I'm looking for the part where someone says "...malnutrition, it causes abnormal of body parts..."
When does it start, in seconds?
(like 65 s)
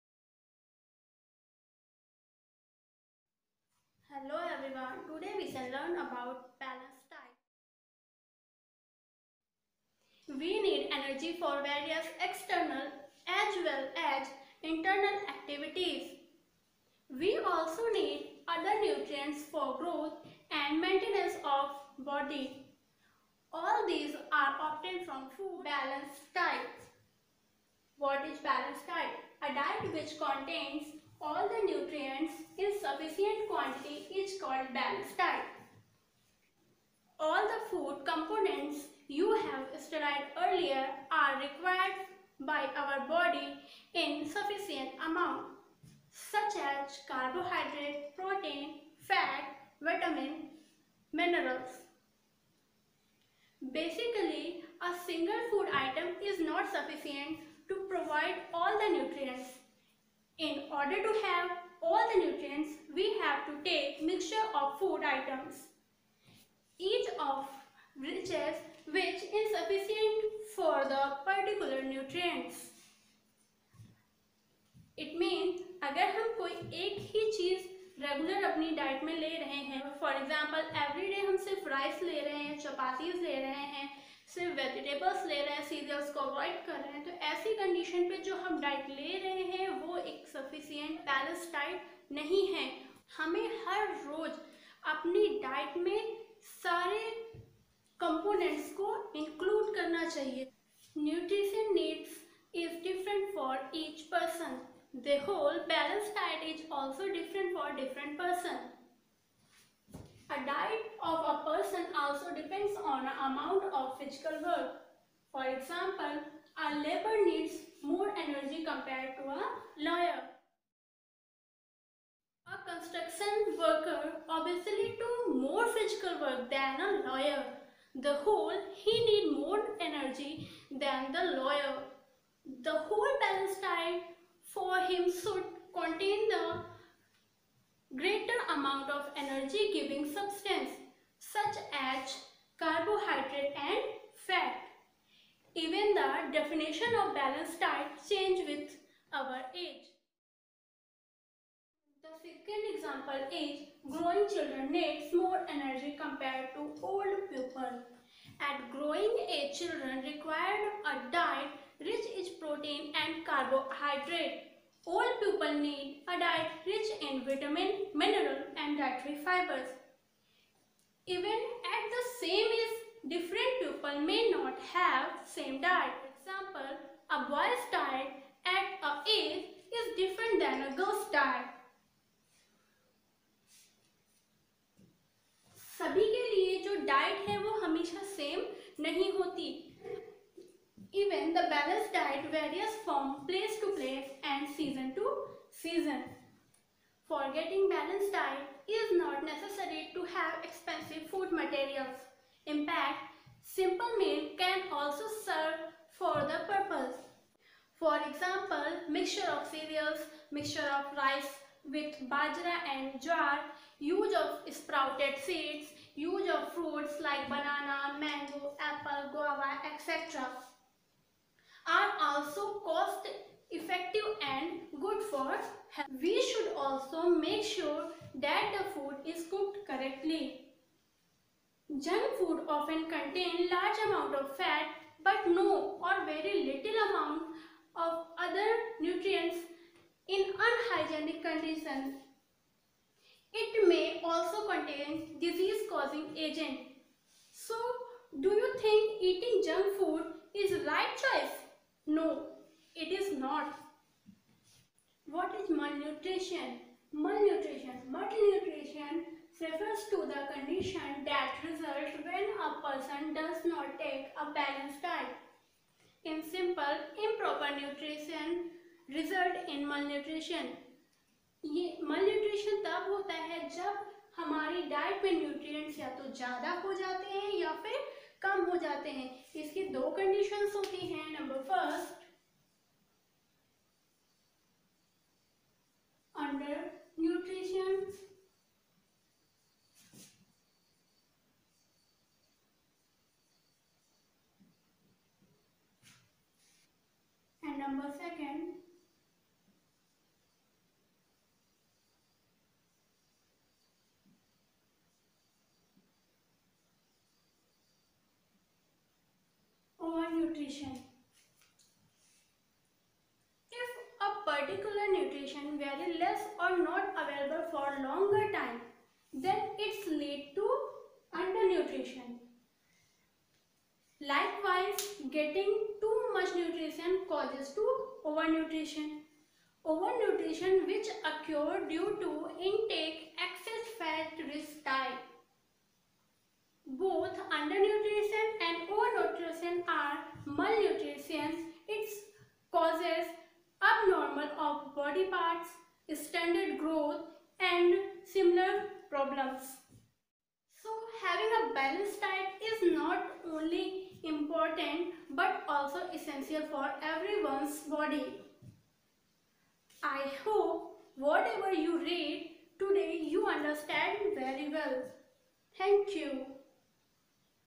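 340 s.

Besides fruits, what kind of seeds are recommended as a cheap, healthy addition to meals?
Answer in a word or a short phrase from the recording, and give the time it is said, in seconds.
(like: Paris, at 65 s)
sprouted seeds, at 214 s.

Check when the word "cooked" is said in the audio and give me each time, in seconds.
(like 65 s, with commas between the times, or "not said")
229 s.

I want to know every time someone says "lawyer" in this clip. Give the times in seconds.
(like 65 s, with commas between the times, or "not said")
119 s, 127 s, 131 s.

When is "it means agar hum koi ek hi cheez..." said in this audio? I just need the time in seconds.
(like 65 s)
75 s.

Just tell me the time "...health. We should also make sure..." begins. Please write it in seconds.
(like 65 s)
225 s.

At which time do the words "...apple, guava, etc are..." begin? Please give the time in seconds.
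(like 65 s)
218 s.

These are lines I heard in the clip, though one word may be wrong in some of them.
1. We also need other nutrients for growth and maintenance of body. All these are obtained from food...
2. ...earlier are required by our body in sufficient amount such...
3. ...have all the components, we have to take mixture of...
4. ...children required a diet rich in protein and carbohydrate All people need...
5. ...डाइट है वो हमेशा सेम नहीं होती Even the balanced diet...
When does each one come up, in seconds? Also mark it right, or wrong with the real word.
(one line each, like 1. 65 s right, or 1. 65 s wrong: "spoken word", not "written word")
1. 17 s right
2. 40 s right
3. 61 s wrong: "nutrients", not "components"
4. 159 s right
5. 186 s right.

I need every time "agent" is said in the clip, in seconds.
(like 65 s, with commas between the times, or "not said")
246 s.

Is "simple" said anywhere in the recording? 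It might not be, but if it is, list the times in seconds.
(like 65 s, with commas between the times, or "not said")
203 s, 266 s.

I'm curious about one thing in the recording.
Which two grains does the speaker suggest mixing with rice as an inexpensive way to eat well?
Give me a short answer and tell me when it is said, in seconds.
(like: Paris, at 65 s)
bajra and jowar, at 212 s.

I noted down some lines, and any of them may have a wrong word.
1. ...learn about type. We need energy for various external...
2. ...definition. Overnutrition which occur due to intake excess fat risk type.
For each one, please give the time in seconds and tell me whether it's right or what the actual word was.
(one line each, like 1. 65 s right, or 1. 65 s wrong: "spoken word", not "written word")
1. 5 s right
2. 328 s wrong: "overnutrition", not "definition".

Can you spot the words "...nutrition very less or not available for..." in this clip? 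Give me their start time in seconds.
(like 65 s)
314 s.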